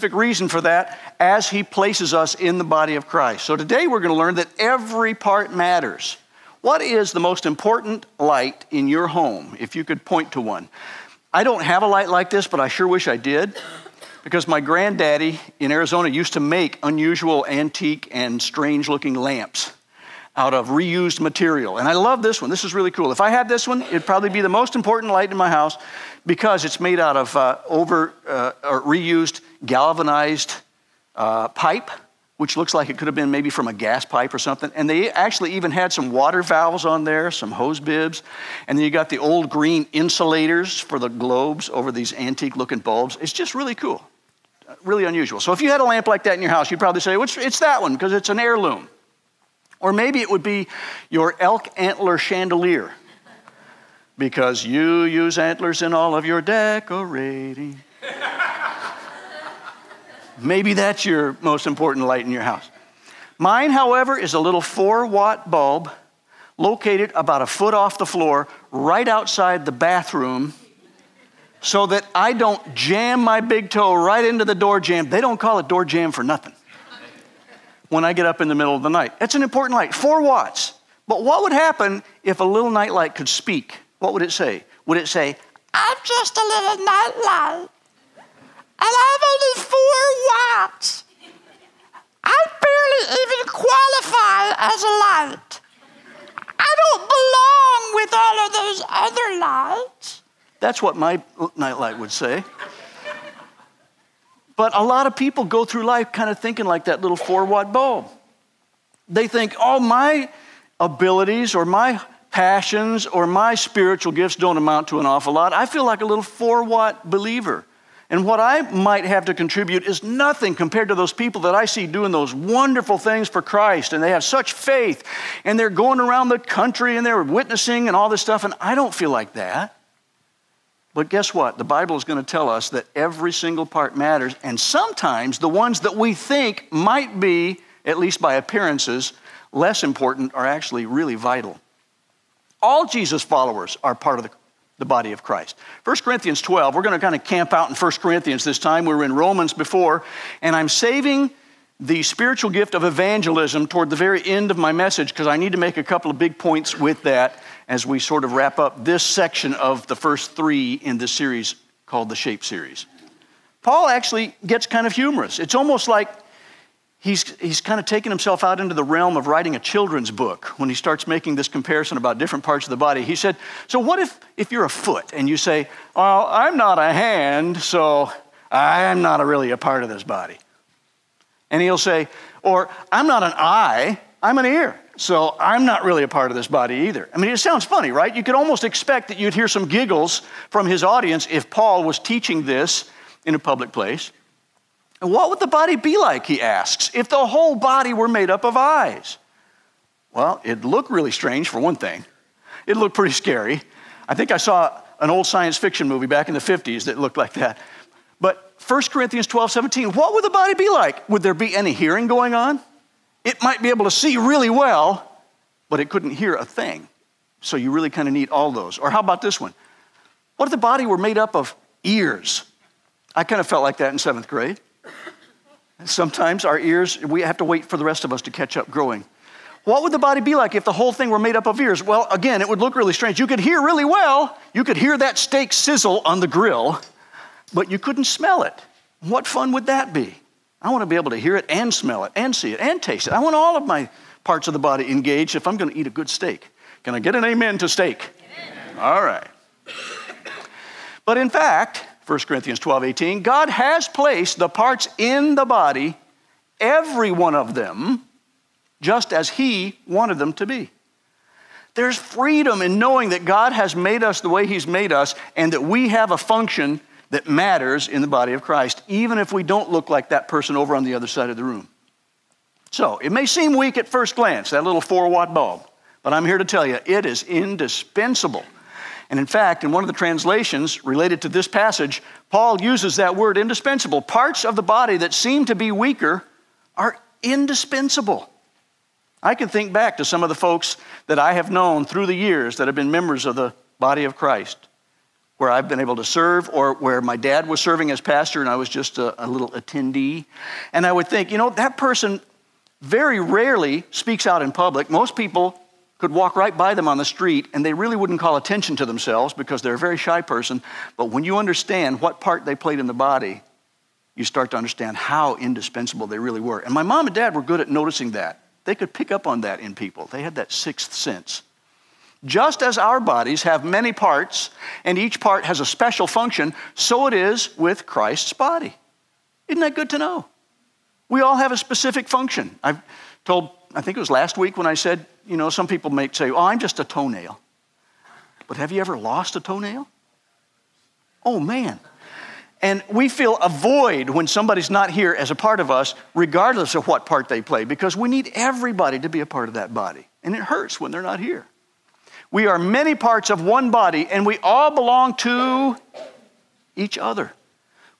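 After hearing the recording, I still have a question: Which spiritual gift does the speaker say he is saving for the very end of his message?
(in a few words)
evangelism.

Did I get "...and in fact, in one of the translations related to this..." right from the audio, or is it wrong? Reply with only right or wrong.
right.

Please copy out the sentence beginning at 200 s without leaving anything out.
Well, it'd look really strange, for one thing.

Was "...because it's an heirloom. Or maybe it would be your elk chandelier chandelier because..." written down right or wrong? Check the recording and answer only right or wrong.
wrong.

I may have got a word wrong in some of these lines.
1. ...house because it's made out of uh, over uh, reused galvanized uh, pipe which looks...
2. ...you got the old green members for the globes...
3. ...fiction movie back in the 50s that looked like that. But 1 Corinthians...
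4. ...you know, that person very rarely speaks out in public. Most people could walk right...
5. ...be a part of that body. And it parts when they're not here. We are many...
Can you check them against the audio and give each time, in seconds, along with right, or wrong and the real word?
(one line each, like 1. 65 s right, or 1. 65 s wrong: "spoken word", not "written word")
1. 25 s right
2. 38 s wrong: "insulators", not "members"
3. 205 s right
4. 301 s right
5. 349 s wrong: "hurts", not "parts".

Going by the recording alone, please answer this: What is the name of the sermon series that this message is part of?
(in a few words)
the Shape Series.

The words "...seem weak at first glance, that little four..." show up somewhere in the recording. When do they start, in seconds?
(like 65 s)
273 s.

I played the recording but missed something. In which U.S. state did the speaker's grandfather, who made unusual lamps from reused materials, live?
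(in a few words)
Arizona.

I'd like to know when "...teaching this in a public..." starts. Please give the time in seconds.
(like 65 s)
191 s.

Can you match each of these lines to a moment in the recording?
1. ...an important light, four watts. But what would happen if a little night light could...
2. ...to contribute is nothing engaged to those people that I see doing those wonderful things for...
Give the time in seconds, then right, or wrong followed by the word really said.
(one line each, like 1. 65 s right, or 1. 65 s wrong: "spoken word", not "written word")
1. 79 s right
2. 119 s wrong: "compared", not "engaged".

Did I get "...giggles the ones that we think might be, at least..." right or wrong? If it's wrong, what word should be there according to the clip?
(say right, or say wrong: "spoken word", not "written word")
wrong: "sometimes", not "giggles".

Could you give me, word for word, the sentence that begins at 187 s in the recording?
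I mean, it sounds funny, right?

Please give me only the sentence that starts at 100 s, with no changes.
That's what my nightlight would say.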